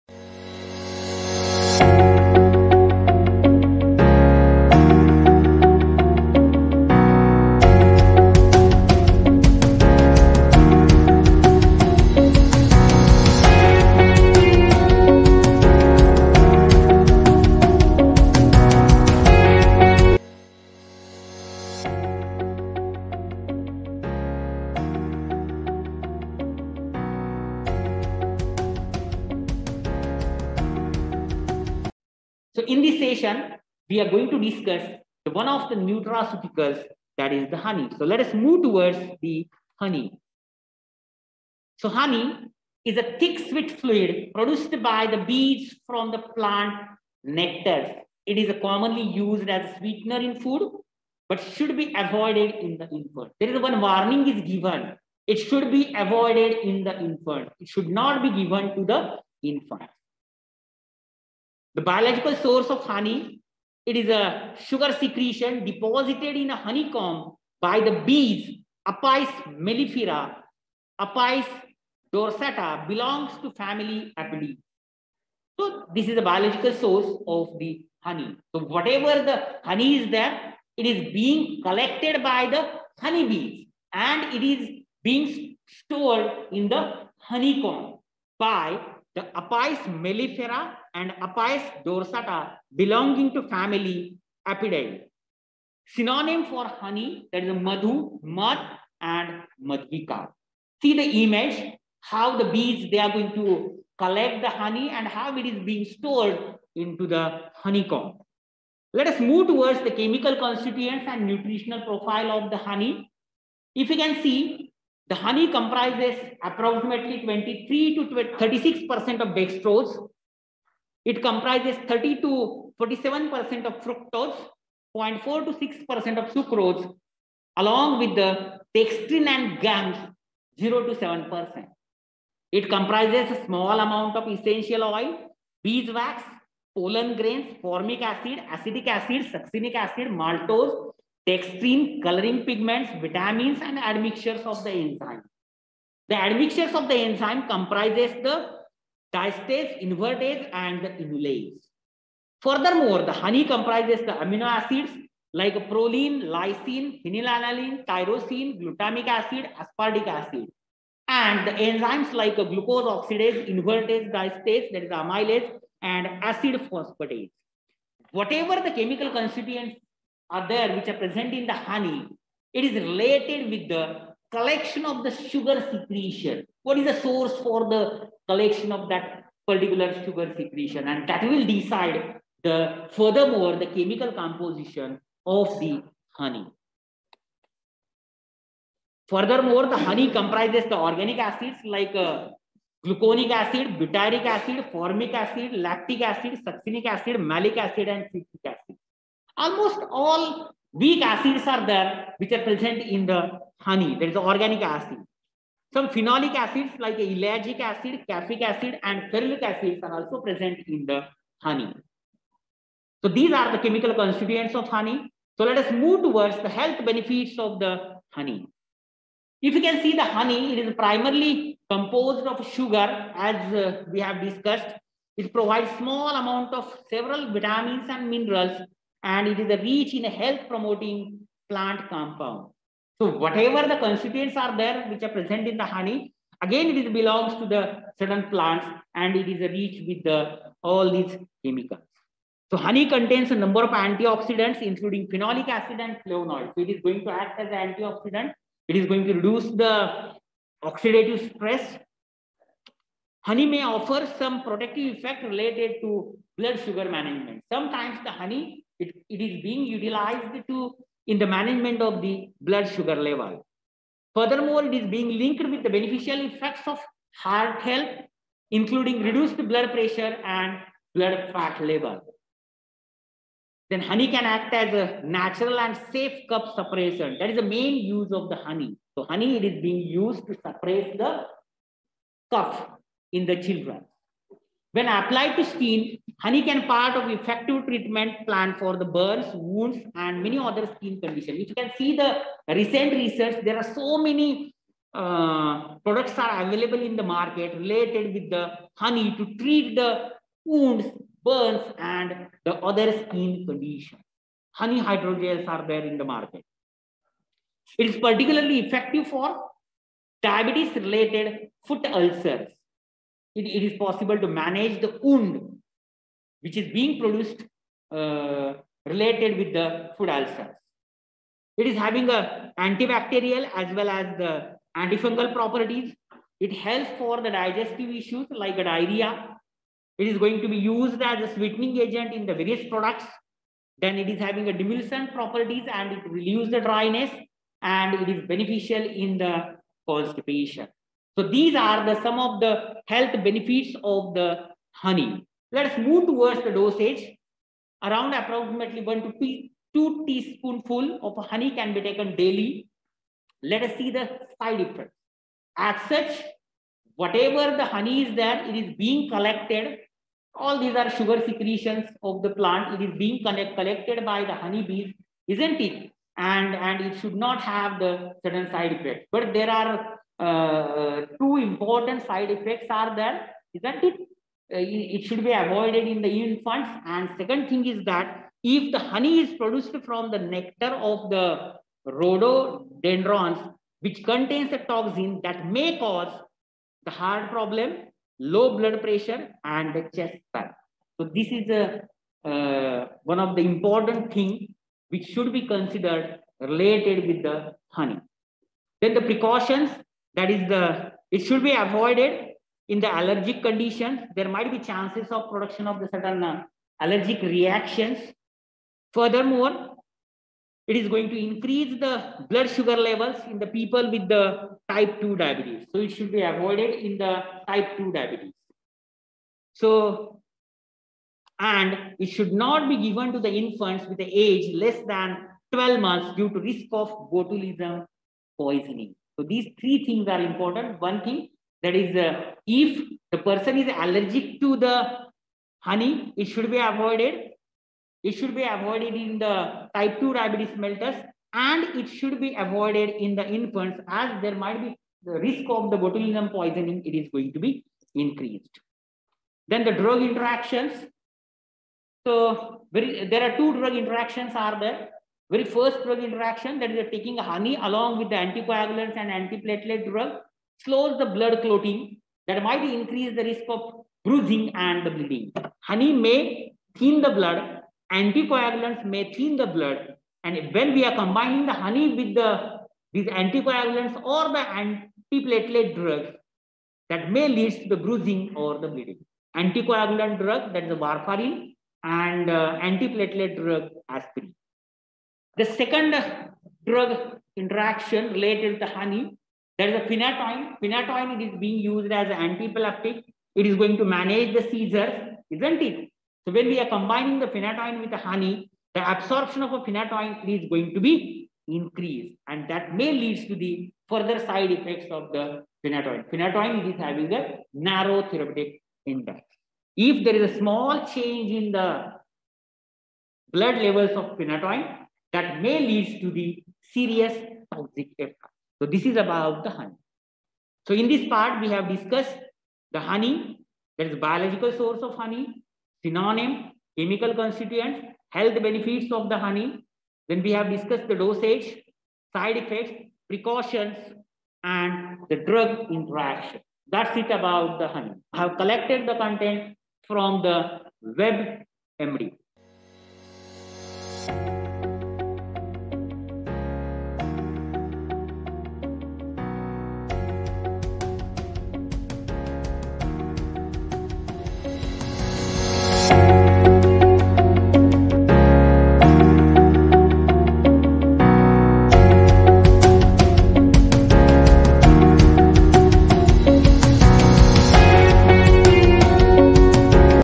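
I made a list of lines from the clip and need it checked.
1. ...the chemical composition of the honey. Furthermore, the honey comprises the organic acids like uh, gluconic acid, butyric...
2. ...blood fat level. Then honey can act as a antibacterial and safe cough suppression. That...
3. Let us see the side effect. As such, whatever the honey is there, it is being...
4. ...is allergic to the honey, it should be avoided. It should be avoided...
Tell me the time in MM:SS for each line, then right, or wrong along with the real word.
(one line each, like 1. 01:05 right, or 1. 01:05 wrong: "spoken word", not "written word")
1. 03:03 right
2. 04:30 wrong: "natural", not "antibacterial"
3. 05:53 right
4. 07:13 right.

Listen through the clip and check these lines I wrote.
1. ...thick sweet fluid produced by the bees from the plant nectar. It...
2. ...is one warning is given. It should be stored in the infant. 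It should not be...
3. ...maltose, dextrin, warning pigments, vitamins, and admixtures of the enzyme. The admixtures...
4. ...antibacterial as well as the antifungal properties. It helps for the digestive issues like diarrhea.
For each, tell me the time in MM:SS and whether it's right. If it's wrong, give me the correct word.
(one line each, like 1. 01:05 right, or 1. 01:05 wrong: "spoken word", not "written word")
1. 00:43 right
2. 00:53 wrong: "avoided", not "stored"
3. 02:20 wrong: "coloring", not "warning"
4. 05:22 right.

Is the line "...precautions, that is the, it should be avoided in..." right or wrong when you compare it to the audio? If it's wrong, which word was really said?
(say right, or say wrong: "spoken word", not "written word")
right.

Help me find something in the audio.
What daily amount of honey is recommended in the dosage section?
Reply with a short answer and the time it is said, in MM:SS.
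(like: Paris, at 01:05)
1 to 2 teaspoonful, at 05:48.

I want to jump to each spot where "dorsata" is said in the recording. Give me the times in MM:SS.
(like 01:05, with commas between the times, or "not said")
01:12, 01:31.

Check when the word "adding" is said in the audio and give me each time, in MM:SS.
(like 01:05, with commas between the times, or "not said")
not said.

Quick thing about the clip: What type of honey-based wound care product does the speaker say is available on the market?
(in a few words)
Honey hydrogels.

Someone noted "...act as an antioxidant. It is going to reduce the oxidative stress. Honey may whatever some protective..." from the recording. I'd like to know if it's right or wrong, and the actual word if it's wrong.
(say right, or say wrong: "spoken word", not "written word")
wrong: "offer", not "whatever".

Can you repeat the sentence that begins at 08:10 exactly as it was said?
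Phenytoin it is being used as an antiepileptic.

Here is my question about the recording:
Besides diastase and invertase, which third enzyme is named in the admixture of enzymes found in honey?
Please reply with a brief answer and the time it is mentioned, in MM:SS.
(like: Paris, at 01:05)
inulase, at 02:31.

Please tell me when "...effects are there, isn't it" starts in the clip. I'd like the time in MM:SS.
06:12.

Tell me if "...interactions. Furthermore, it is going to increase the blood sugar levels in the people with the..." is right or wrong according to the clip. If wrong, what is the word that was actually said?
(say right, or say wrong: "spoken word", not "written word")
wrong: "reactions", not "interactions".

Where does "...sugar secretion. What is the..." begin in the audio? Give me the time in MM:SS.
02:55.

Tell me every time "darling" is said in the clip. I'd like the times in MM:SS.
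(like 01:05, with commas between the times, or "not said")
not said.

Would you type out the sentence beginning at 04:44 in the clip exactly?
When applied to skin, Honey can part of effective treatment plan for the burns, wounds, and many other skin conditions.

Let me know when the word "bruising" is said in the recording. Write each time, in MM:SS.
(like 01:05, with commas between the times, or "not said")
07:44, 07:57.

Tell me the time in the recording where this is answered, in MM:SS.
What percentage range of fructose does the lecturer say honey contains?
02:01.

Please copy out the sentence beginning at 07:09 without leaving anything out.
So these three things are important.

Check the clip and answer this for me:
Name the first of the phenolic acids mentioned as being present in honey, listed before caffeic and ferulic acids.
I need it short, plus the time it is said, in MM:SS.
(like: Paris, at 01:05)
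ellagic acid, at 03:26.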